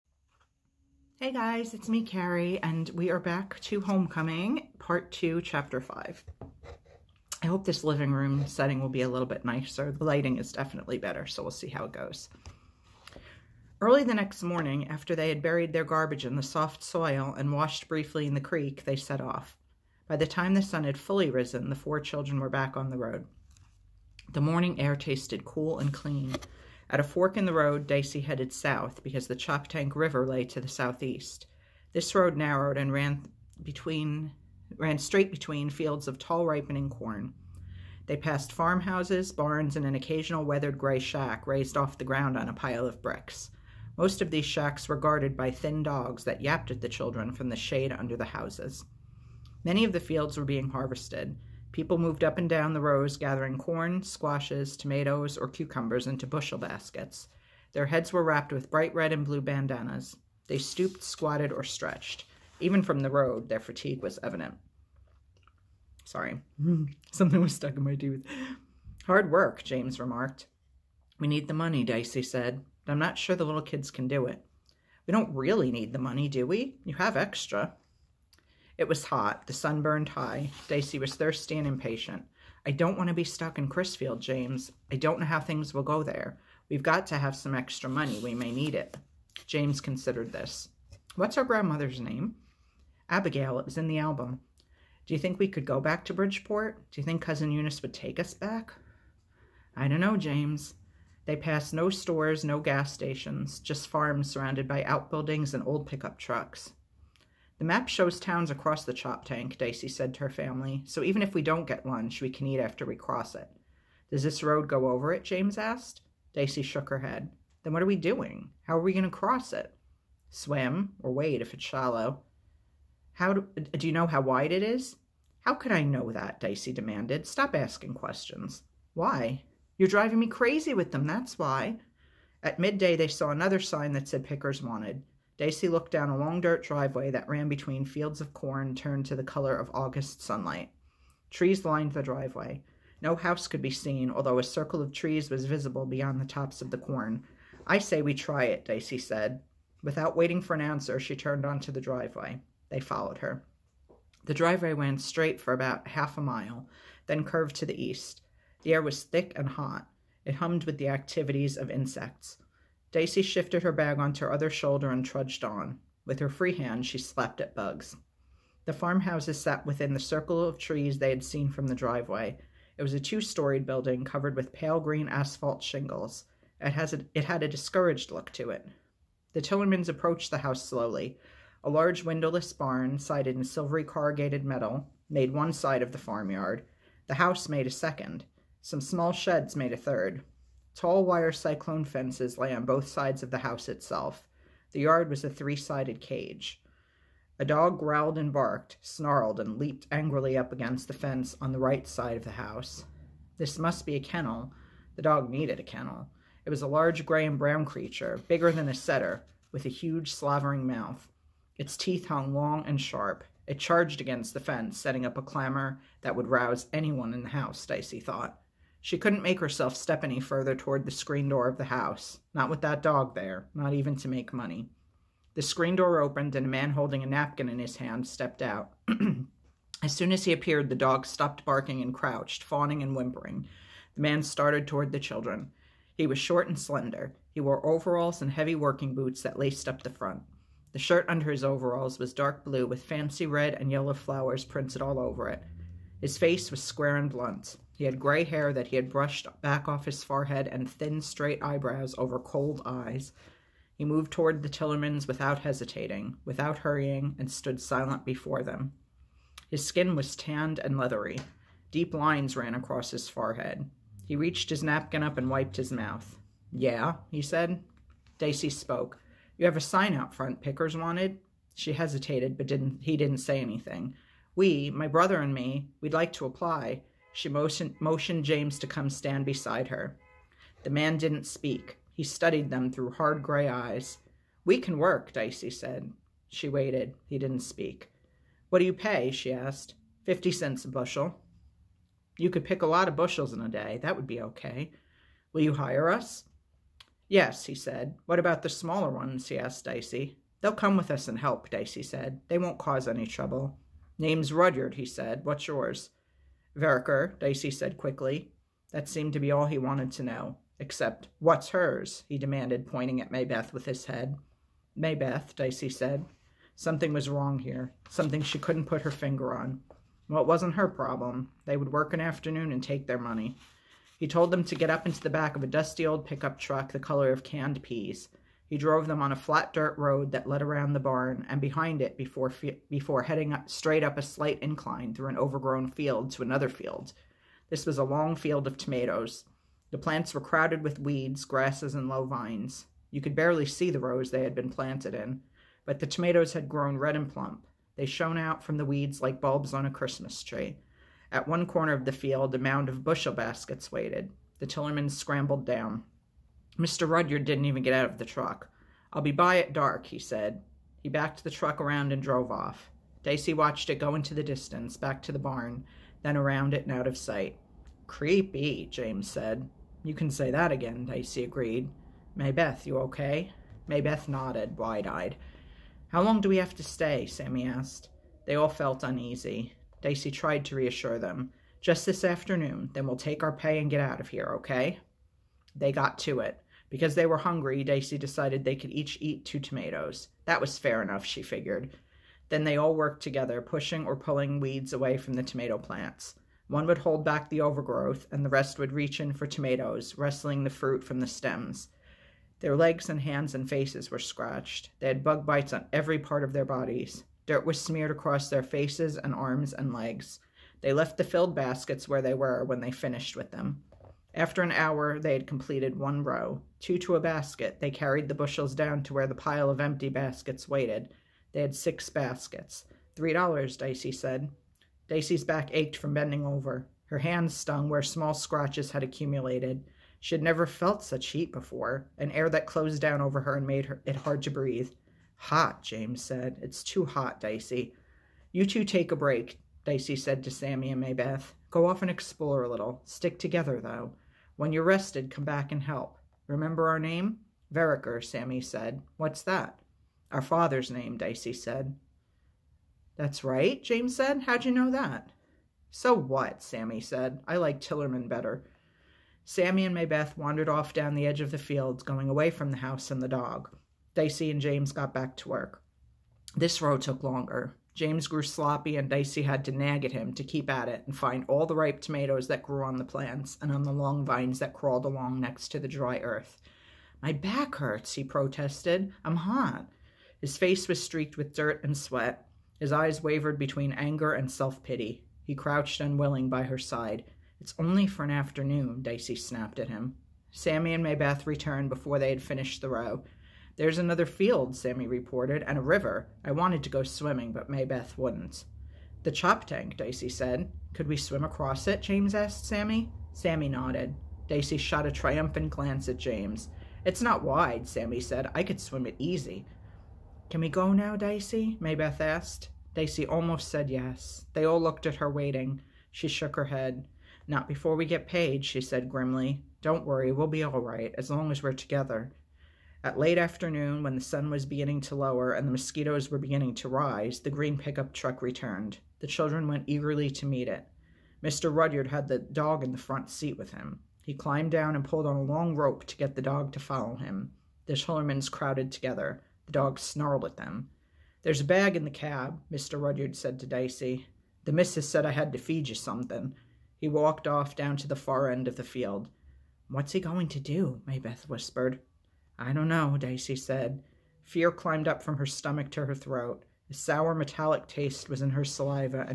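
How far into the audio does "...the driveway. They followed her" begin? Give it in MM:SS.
02:31.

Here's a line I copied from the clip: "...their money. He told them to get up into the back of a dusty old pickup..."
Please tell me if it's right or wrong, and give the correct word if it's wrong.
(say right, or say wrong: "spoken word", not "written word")
right.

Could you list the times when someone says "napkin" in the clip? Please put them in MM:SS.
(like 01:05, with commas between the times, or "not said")
03:47, 04:24.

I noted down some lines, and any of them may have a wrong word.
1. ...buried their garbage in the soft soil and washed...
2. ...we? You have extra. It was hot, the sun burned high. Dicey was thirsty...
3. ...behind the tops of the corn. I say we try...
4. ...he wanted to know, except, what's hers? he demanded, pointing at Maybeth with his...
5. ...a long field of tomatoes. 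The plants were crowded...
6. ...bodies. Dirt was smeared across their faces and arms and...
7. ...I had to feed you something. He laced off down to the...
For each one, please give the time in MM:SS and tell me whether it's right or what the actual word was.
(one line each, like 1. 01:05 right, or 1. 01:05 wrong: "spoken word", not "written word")
1. 00:15 right
2. 01:16 right
3. 02:25 wrong: "beyond", not "behind"
4. 05:09 right
5. 05:37 right
6. 06:46 right
7. 09:05 wrong: "walked", not "laced".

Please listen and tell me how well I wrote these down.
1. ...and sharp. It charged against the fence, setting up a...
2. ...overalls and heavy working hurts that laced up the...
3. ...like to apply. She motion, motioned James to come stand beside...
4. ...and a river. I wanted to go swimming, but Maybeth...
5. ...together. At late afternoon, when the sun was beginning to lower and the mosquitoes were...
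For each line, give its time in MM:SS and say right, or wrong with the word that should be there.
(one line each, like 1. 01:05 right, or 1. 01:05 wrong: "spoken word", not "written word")
1. 03:32 right
2. 03:57 wrong: "boots", not "hurts"
3. 04:35 right
4. 08:15 right
5. 08:41 right.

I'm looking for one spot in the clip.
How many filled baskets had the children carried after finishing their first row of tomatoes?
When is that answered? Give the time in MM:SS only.
07:01.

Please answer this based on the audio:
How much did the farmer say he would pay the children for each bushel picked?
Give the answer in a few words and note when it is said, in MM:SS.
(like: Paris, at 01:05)
50 cents, at 04:50.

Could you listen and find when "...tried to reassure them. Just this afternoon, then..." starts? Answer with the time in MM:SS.
06:20.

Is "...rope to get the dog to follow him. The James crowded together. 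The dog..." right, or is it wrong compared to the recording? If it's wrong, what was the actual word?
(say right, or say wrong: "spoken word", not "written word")
wrong: "Tillermans", not "James".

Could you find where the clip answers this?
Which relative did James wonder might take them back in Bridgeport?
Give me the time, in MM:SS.
01:37.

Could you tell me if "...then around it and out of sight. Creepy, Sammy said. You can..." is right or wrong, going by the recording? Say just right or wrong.
wrong.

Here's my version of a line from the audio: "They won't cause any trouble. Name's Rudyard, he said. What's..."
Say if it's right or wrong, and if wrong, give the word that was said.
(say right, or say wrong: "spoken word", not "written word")
right.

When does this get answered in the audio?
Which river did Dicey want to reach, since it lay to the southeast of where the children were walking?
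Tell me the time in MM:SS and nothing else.
00:29.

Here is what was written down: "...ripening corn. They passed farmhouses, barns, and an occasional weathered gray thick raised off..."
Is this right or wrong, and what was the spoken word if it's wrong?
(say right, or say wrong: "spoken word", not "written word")
wrong: "shack", not "thick".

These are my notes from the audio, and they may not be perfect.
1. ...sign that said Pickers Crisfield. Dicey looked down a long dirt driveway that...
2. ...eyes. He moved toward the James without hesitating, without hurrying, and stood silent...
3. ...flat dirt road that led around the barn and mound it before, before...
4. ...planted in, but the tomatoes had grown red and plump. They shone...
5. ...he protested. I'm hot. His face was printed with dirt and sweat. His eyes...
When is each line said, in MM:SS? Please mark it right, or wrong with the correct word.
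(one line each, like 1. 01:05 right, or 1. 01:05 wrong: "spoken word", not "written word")
1. 02:13 wrong: "Wanted", not "Crisfield"
2. 04:12 wrong: "Tillermans", not "James"
3. 05:29 wrong: "behind", not "mound"
4. 05:44 right
5. 07:57 wrong: "streaked", not "printed".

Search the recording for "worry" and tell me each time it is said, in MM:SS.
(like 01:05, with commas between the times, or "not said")
08:39.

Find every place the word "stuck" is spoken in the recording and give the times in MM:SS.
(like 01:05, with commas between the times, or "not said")
01:07, 01:23.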